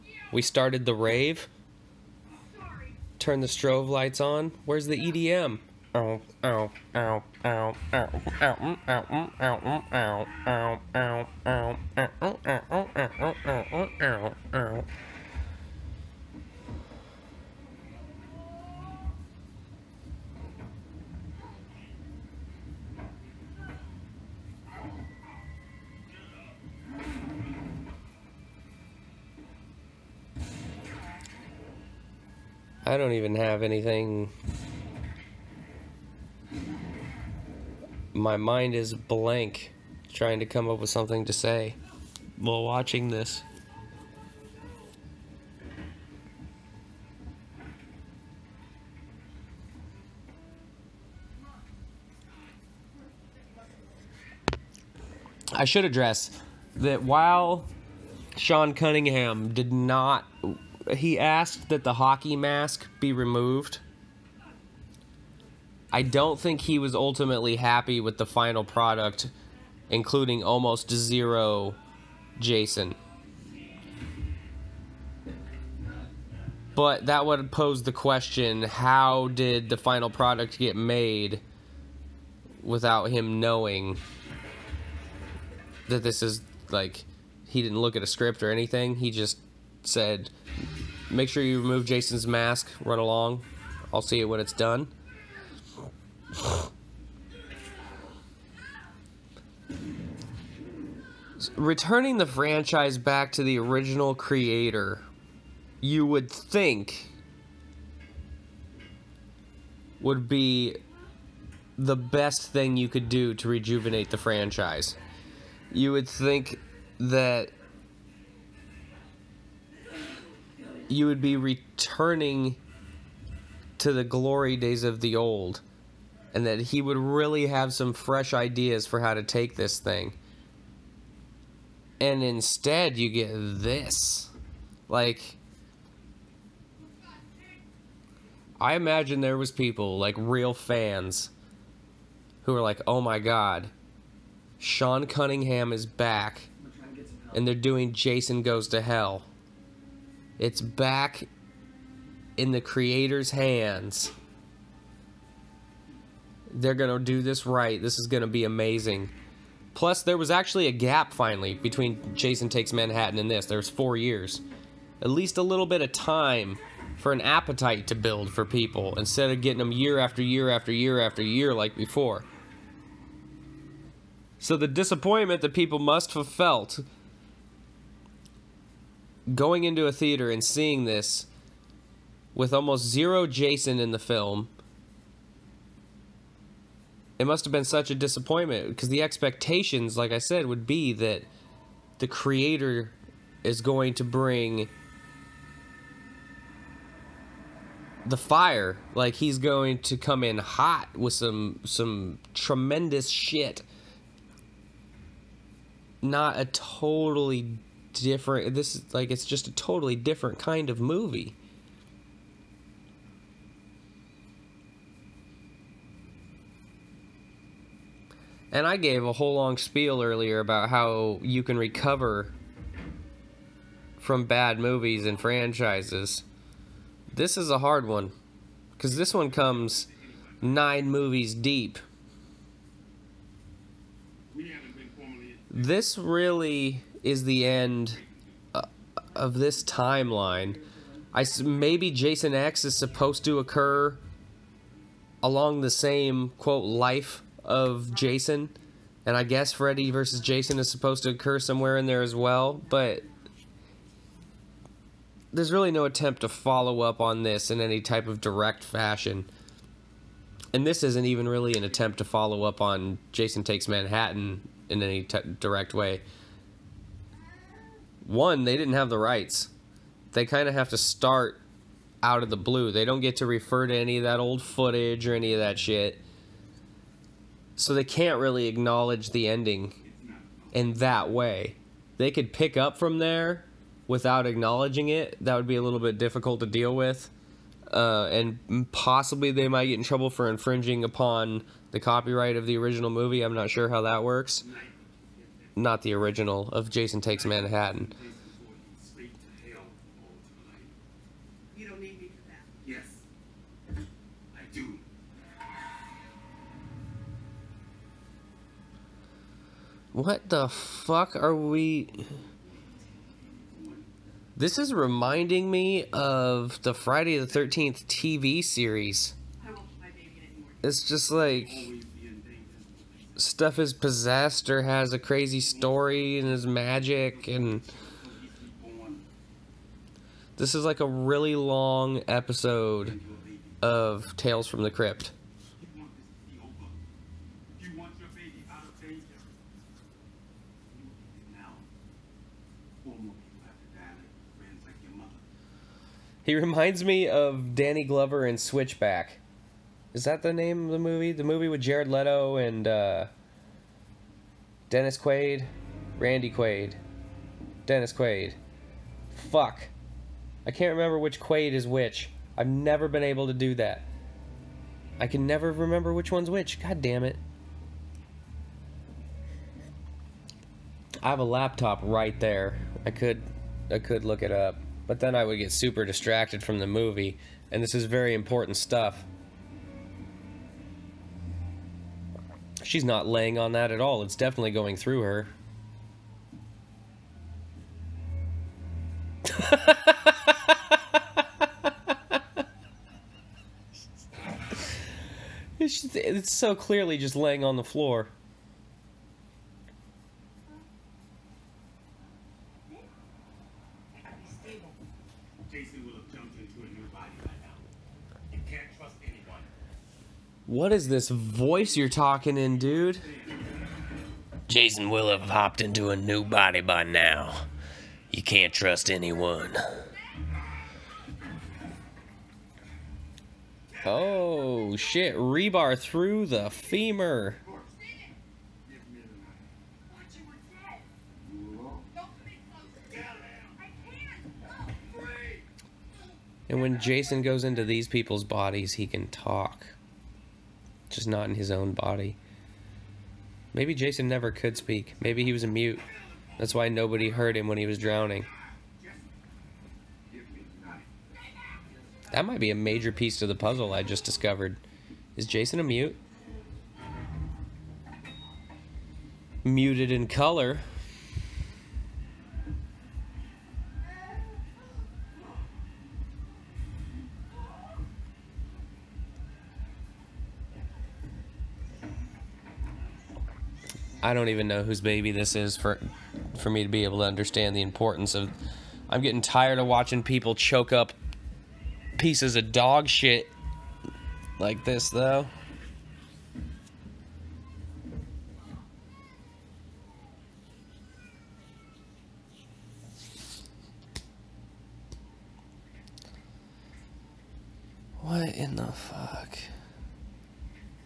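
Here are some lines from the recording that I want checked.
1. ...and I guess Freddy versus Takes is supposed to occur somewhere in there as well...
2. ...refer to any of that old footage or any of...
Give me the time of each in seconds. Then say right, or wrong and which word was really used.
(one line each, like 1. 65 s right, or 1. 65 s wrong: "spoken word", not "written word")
1. 249 s wrong: "Jason", not "Takes"
2. 273 s right.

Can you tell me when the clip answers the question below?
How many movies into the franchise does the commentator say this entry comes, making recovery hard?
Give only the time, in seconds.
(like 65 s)
230 s.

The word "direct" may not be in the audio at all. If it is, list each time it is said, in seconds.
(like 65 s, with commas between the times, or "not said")
258 s, 265 s.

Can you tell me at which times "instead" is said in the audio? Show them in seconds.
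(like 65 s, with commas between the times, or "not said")
132 s, 168 s.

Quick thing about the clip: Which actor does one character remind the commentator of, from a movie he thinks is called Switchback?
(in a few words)
Danny Glover.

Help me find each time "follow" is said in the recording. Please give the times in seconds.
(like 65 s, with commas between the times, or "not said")
256 s, 262 s.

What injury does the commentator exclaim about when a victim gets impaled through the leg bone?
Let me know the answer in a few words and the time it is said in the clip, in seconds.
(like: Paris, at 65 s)
Rebar through the femur, at 425 s.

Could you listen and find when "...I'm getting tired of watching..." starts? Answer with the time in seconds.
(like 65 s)
478 s.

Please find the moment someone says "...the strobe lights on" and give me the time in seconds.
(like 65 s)
3 s.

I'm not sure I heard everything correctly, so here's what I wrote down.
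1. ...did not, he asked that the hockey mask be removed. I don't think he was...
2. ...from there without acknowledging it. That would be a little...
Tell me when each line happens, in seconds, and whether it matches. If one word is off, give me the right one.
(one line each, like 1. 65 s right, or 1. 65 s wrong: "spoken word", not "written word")
1. 59 s right
2. 282 s right.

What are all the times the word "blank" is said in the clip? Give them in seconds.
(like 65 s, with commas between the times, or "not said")
38 s.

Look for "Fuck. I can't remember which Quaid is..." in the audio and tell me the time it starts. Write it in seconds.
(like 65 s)
359 s.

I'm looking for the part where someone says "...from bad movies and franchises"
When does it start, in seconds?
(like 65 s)
223 s.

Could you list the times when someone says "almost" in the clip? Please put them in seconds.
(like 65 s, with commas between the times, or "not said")
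70 s, 182 s.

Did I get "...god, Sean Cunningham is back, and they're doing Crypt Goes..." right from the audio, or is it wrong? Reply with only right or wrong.
wrong.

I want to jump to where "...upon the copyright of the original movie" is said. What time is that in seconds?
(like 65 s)
290 s.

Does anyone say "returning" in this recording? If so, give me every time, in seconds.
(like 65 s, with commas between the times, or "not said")
101 s, 121 s.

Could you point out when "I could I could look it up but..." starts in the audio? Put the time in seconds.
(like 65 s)
372 s.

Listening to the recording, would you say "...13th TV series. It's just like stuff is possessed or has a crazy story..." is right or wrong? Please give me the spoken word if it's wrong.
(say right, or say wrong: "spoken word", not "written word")
right.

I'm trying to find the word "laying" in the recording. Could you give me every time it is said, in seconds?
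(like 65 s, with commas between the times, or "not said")
383 s, 397 s.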